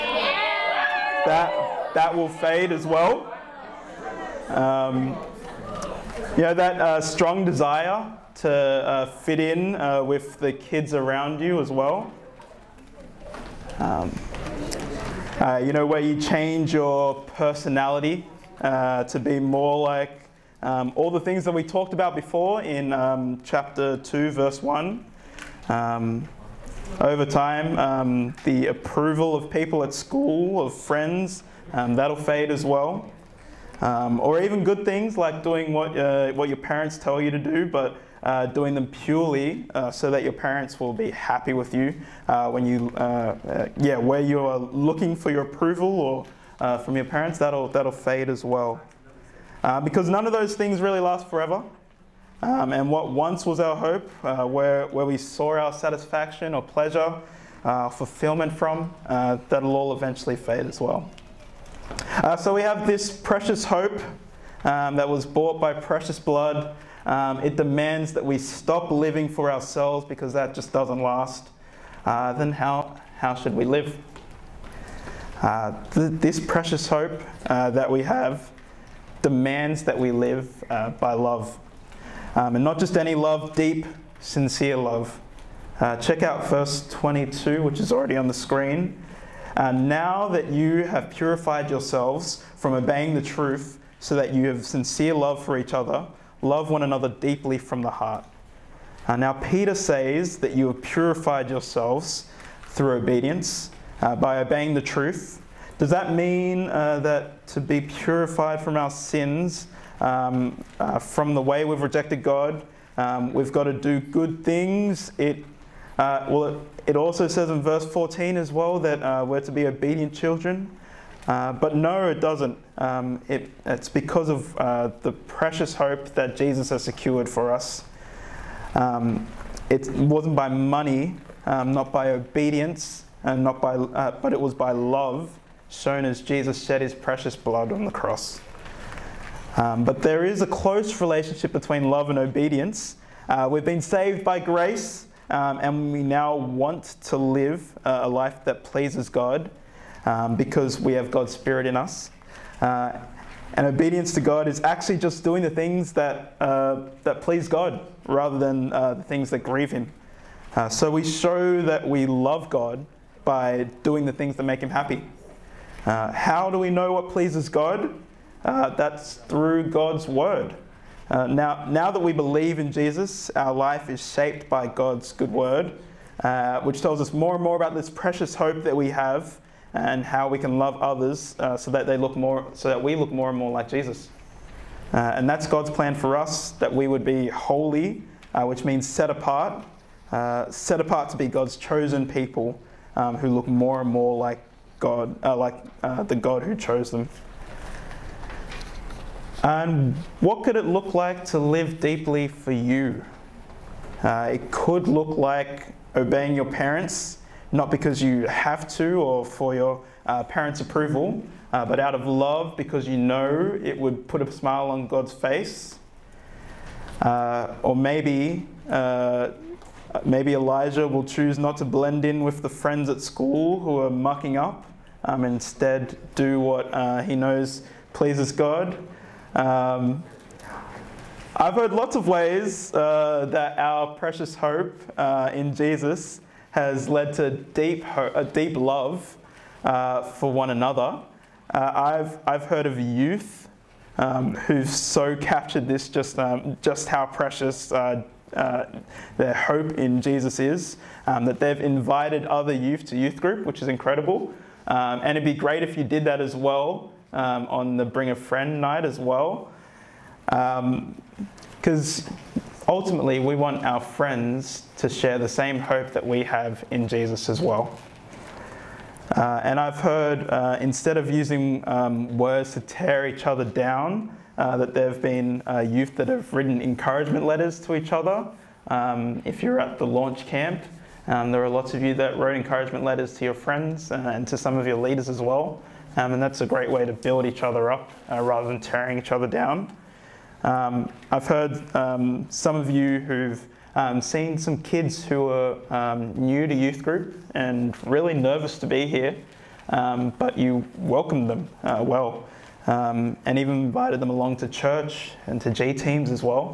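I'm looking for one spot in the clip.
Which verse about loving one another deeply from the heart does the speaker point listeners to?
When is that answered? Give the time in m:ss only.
1:26.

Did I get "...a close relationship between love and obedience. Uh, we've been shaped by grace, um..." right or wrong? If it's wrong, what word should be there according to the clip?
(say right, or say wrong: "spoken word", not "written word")
wrong: "saved", not "shaped".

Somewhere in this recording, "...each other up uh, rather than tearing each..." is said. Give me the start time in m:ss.
4:47.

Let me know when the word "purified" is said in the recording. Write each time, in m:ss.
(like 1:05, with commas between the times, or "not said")
1:31, 1:40, 1:47.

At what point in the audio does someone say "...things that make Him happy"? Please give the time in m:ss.
2:44.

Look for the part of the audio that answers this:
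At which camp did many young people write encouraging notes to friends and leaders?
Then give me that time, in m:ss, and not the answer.
4:39.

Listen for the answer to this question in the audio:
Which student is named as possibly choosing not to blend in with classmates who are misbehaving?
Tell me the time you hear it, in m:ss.
3:40.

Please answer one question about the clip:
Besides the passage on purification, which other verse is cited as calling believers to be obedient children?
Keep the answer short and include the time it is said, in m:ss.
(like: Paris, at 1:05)
verse 14, at 1:57.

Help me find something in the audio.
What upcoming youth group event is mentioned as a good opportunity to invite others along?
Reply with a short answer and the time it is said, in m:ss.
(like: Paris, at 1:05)
Bring a Friend night, at 4:17.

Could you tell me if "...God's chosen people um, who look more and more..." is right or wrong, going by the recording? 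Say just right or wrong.
right.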